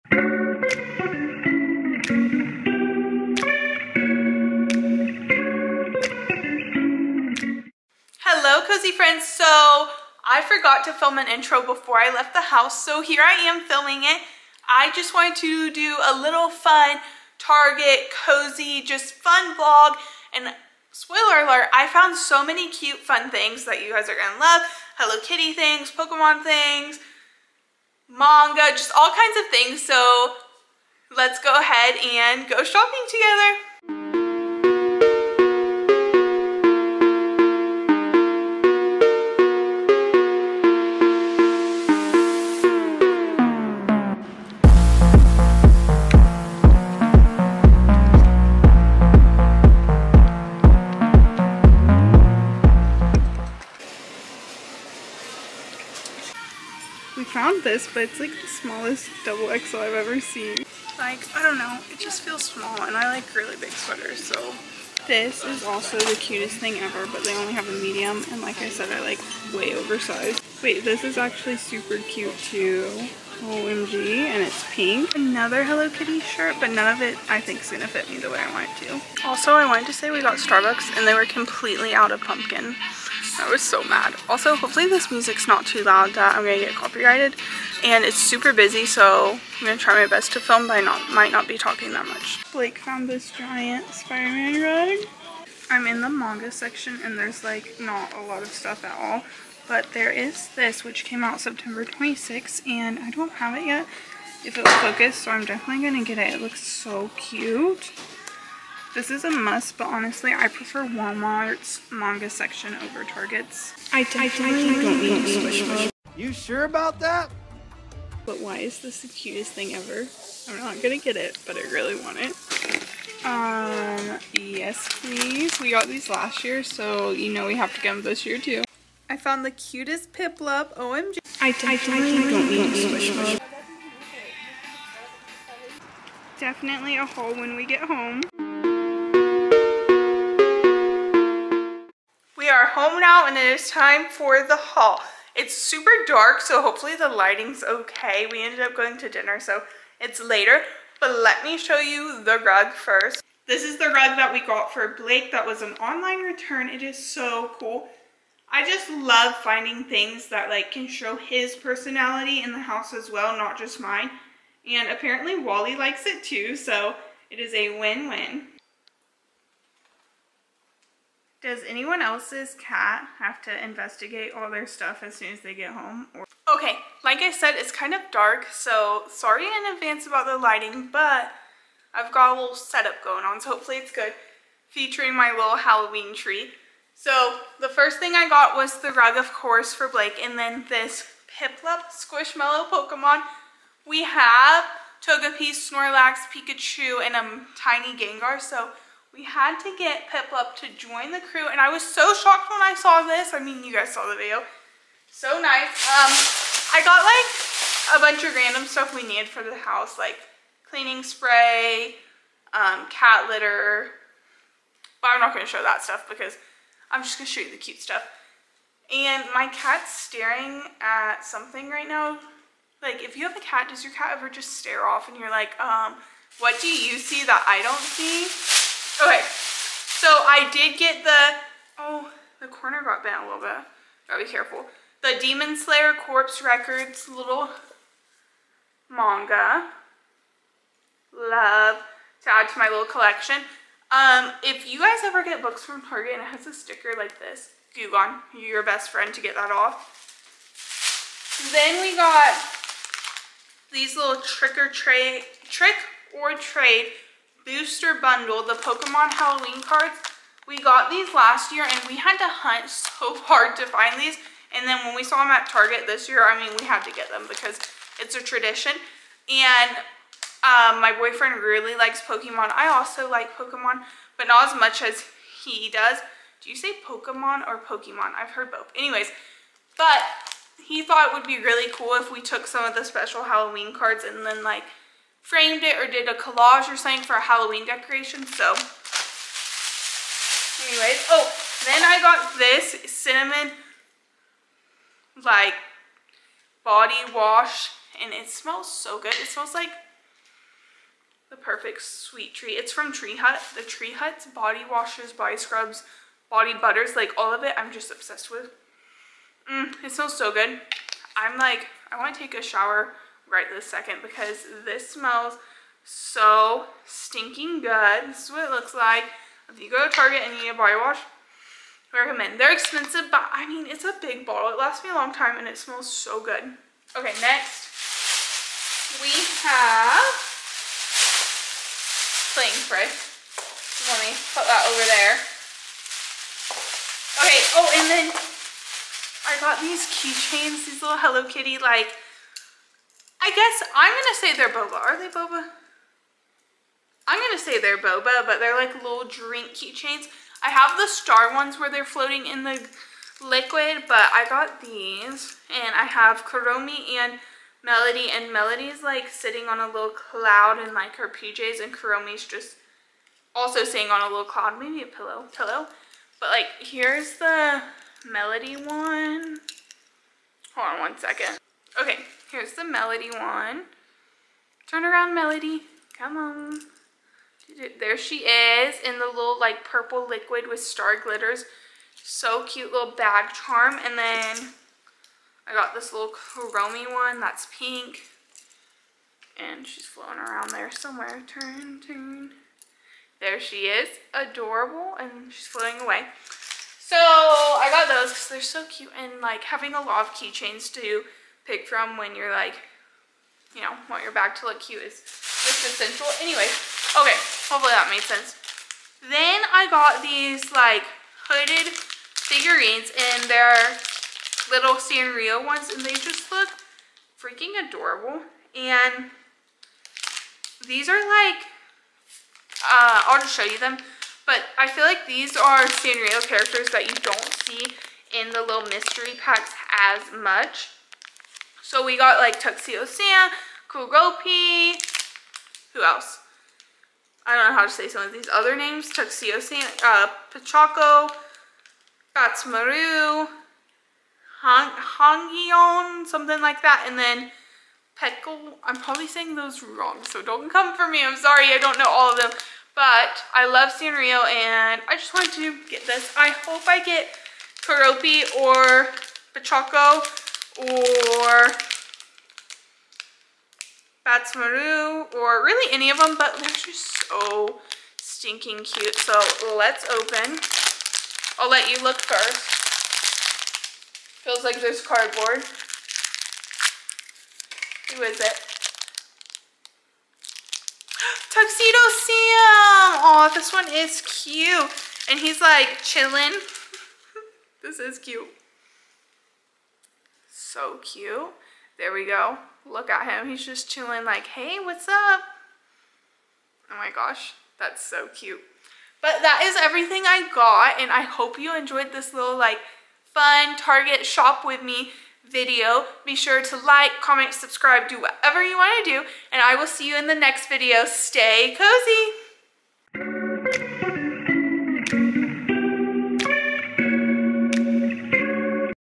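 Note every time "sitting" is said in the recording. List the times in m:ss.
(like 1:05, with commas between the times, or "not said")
5:59, 6:03.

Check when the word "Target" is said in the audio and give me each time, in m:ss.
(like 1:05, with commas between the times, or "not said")
0:17, 1:53, 4:05, 4:25, 5:19, 8:23.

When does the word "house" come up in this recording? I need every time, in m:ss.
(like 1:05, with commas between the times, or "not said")
0:12, 2:42, 3:29.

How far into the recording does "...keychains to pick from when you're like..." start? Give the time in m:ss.
6:40.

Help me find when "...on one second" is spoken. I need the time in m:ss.
6:10.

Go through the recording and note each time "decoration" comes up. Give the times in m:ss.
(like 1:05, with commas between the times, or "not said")
4:47.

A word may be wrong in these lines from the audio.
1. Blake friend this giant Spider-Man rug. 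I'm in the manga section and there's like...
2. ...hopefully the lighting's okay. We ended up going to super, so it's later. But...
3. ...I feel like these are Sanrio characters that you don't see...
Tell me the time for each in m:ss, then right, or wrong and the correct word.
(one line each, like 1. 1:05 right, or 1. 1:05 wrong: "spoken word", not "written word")
1. 1:32 wrong: "found", not "friend"
2. 2:26 wrong: "dinner", not "super"
3. 7:04 right.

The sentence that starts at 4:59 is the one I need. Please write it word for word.
It smells like the perfect sweet treat.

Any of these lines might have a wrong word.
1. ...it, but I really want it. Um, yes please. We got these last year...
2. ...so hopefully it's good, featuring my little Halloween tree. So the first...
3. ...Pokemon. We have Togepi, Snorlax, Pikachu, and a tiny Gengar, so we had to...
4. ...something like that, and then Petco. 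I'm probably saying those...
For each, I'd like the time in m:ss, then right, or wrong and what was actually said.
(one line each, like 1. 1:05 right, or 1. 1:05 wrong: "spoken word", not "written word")
1. 2:01 right
2. 3:03 right
3. 3:12 right
4. 7:26 right.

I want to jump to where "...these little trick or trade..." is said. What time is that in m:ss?
4:13.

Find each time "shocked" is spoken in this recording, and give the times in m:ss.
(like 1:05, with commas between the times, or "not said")
3:22.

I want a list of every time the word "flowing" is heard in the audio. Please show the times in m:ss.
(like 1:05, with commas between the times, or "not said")
not said.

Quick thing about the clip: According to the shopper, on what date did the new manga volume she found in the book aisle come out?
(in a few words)
September 26th.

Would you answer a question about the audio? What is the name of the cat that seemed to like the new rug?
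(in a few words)
Wally.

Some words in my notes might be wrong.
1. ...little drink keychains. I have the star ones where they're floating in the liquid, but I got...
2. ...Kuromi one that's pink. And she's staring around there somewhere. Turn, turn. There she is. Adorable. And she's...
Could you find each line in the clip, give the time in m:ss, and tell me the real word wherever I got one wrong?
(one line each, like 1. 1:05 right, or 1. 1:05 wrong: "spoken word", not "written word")
1. 5:48 right
2. 6:26 wrong: "floating", not "staring".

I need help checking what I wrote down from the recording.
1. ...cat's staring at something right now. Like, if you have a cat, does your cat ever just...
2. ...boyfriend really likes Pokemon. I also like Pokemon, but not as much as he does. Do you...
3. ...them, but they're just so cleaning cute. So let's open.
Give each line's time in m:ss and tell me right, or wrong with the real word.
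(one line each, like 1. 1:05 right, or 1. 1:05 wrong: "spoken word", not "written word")
1. 3:39 right
2. 4:30 right
3. 7:45 wrong: "stinking", not "cleaning".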